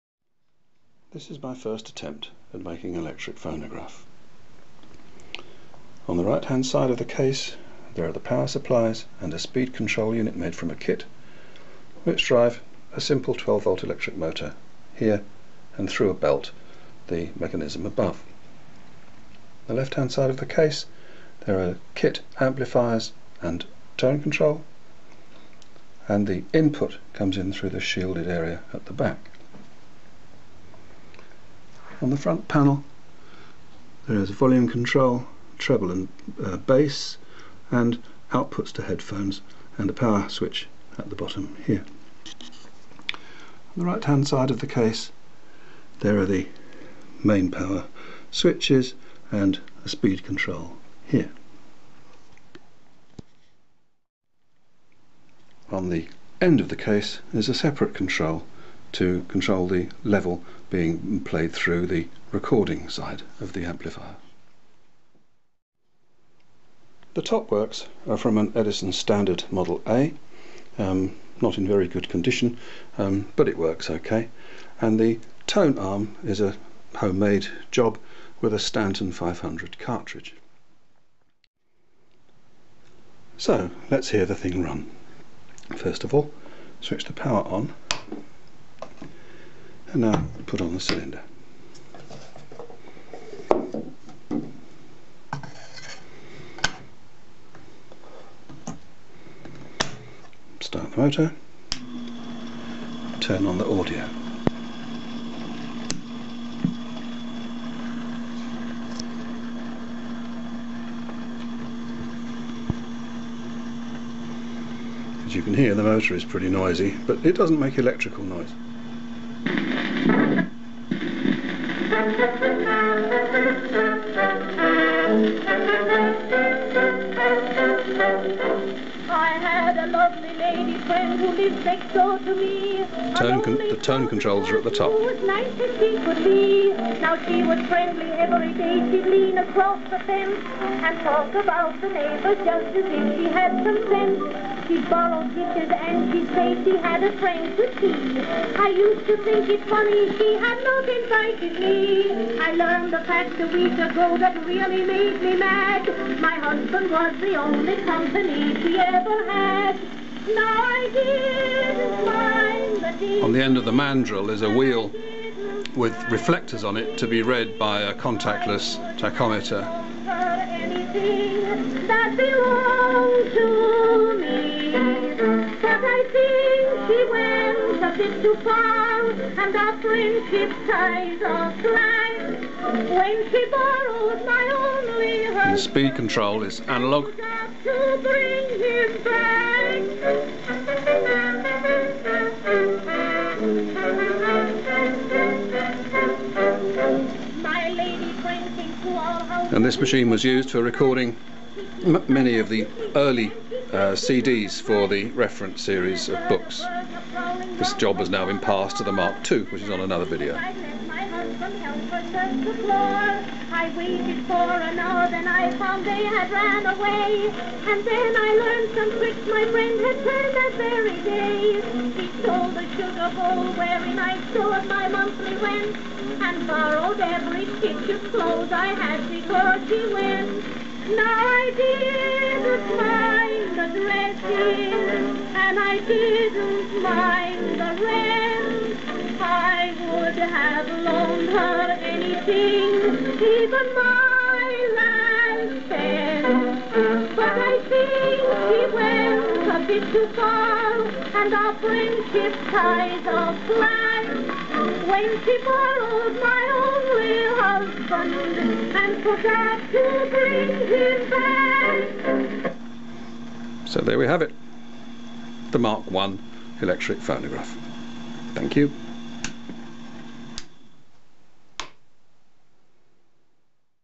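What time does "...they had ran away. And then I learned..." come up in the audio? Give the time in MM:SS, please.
03:35.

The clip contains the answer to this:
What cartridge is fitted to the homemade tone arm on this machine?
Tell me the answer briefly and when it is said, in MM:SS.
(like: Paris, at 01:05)
Stanton 500, at 01:18.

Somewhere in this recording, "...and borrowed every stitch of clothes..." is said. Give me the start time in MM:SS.
03:46.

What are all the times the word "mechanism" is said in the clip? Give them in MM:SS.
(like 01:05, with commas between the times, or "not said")
00:17.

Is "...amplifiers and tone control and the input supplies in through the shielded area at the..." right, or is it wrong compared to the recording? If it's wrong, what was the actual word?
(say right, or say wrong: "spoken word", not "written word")
wrong: "comes", not "supplies".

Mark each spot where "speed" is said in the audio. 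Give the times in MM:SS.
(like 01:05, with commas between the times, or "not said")
00:09, 00:49, 03:05.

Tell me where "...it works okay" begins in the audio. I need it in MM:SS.
01:13.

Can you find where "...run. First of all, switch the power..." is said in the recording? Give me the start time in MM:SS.
01:24.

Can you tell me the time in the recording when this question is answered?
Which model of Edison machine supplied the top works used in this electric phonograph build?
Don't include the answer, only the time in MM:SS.
01:08.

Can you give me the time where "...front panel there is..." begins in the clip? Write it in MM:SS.
00:32.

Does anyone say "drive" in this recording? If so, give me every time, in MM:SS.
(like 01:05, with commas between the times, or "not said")
00:12.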